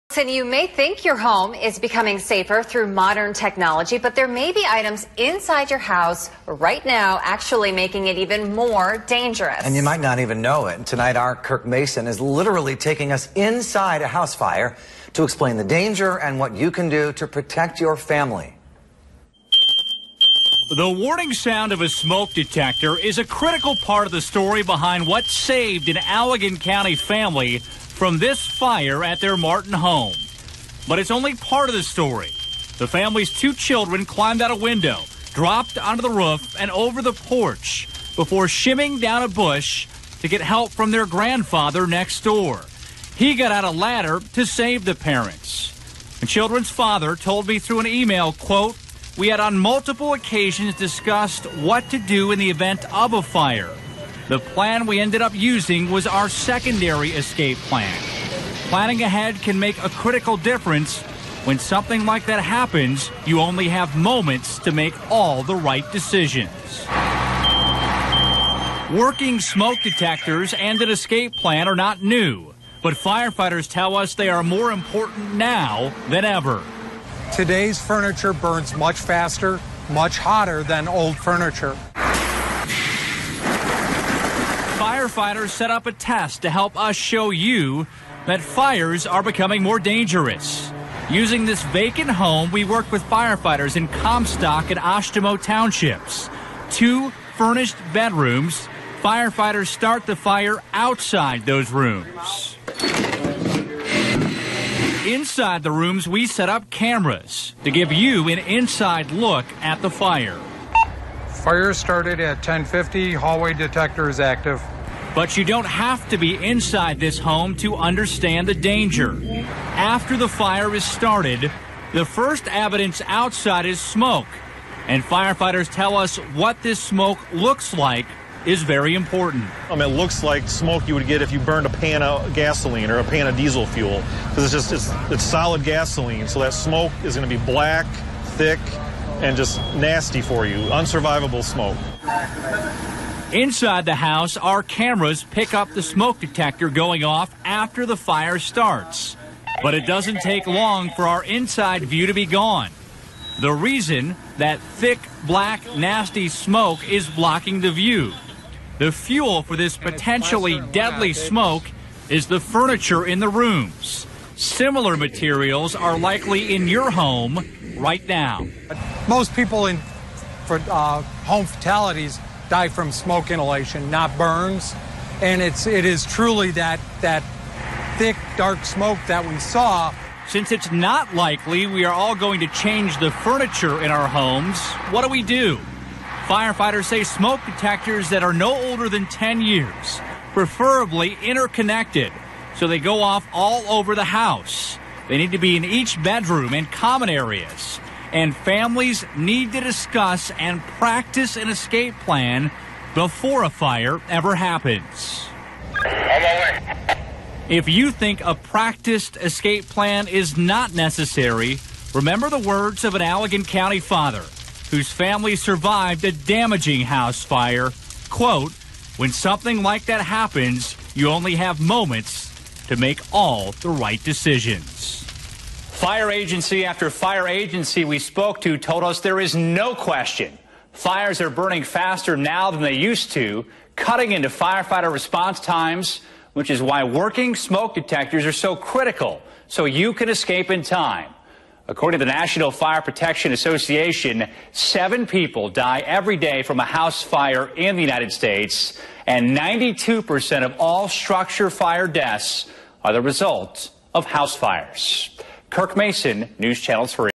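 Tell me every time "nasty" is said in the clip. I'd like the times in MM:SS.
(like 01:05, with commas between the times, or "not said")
02:19, 02:35.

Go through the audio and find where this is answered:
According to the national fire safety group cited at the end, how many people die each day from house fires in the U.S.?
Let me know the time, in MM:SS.
04:04.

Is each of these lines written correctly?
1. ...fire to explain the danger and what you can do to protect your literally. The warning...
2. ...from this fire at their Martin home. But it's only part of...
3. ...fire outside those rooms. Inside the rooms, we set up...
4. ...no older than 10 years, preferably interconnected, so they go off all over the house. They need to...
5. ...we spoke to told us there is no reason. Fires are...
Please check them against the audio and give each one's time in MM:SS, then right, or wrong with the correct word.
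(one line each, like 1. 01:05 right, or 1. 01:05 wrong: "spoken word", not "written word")
1. 00:14 wrong: "family", not "literally"
2. 00:28 right
3. 01:40 right
4. 03:08 right
5. 03:47 wrong: "question", not "reason".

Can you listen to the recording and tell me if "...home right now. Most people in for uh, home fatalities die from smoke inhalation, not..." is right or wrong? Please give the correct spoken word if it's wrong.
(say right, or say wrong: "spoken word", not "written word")
right.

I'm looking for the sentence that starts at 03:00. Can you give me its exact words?
Since it's not likely we are all going to change the furniture in our homes, what do we do?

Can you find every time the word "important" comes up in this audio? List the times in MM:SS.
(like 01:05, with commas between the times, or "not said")
01:14, 02:08.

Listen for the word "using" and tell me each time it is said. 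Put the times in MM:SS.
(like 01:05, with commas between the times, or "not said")
00:55, 01:31.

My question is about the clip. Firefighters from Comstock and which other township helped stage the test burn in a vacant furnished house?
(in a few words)
Oshtemo.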